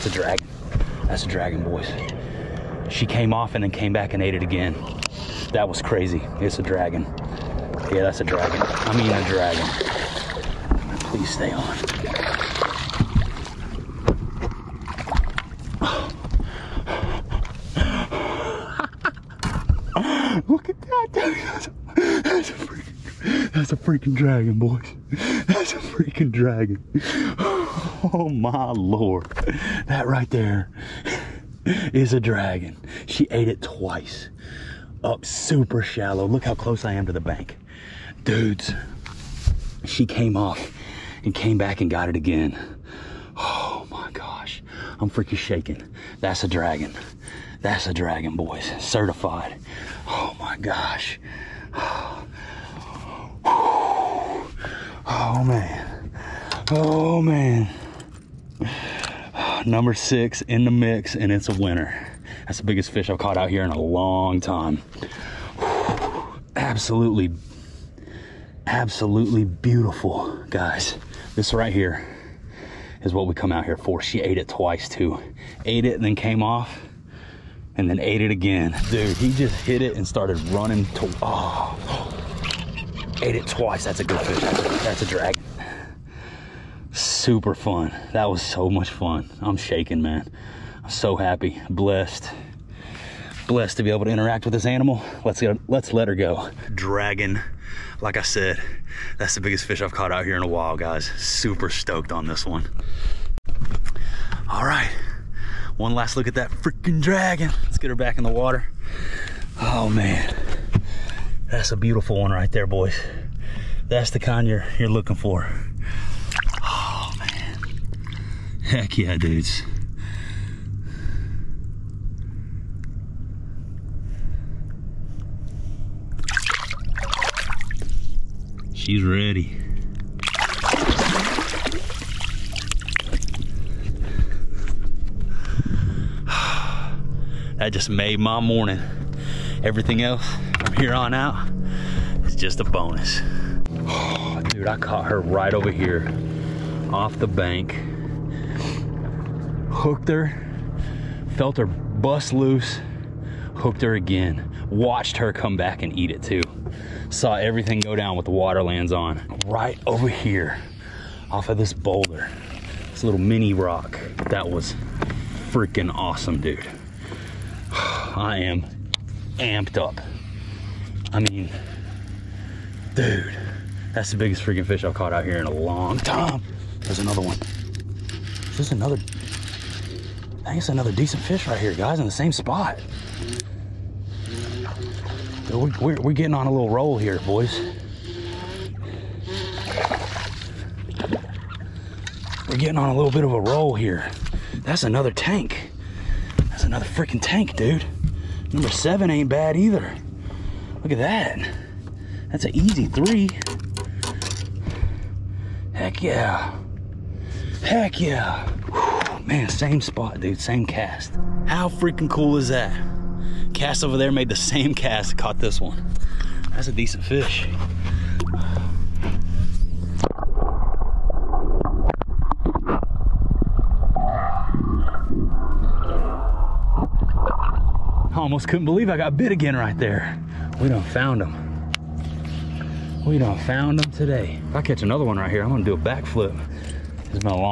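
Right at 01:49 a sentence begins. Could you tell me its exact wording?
Oh man, that's a beautiful one right there, boys.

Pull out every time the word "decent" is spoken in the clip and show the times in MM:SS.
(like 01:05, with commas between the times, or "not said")
03:00, 03:36.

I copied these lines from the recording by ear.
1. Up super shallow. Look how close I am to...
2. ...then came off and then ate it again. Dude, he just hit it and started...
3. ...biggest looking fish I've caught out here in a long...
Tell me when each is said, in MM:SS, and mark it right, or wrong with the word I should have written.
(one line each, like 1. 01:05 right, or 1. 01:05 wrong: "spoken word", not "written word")
1. 00:35 right
2. 01:16 right
3. 02:54 wrong: "freaking", not "looking".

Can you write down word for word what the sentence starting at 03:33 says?
Cast over there made the same cast, caught this one.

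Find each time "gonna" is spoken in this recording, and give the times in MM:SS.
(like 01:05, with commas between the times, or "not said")
03:55.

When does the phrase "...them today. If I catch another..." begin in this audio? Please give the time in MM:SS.
03:53.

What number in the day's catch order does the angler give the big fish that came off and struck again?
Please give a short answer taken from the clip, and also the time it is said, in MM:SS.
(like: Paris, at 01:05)
6, at 00:59.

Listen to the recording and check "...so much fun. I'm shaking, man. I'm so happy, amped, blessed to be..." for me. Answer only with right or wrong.
wrong.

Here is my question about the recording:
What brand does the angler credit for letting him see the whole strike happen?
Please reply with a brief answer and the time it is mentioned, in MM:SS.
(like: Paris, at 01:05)
WaterLands, at 02:38.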